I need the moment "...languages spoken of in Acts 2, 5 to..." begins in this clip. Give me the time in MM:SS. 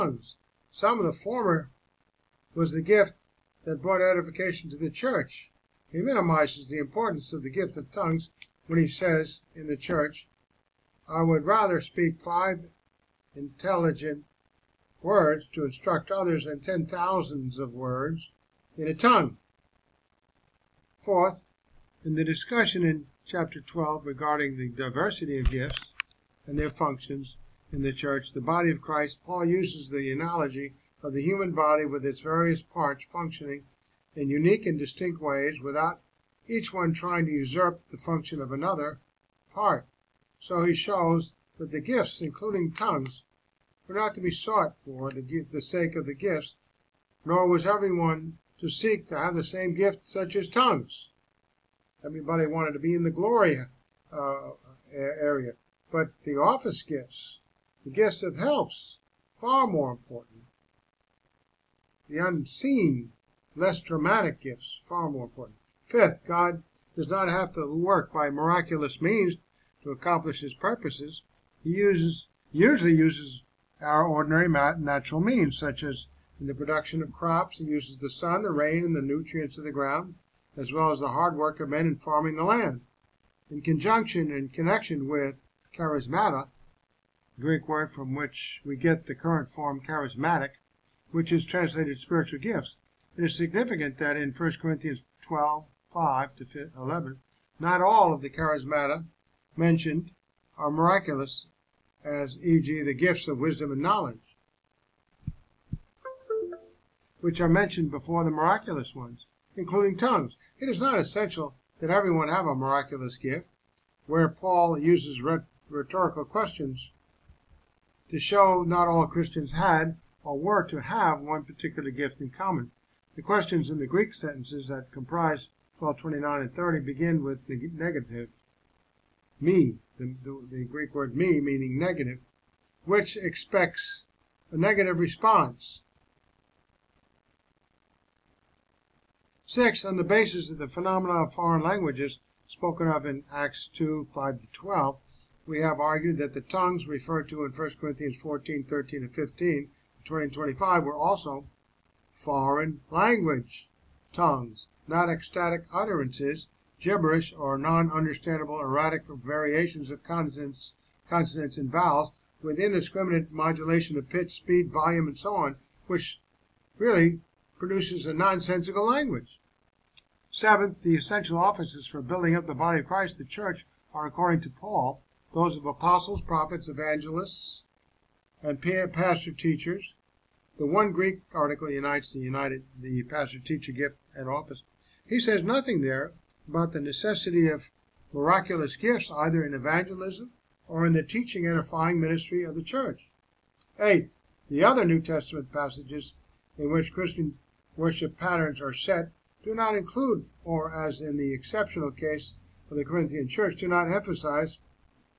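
02:21.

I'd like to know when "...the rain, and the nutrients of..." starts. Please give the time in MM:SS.
01:18.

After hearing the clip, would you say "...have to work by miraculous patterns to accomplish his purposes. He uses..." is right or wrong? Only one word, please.
wrong.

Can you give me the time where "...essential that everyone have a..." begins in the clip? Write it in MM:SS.
01:50.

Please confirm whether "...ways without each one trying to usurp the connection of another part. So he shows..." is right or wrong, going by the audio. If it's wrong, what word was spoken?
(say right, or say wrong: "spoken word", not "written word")
wrong: "function", not "connection".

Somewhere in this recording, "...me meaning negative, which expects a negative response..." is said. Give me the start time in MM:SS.
02:11.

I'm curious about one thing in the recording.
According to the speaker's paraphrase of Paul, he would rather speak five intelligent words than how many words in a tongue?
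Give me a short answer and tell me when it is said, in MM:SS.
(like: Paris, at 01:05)
10,000, at 00:16.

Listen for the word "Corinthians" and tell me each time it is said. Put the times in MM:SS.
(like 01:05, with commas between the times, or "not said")
01:34, 02:27, 03:22.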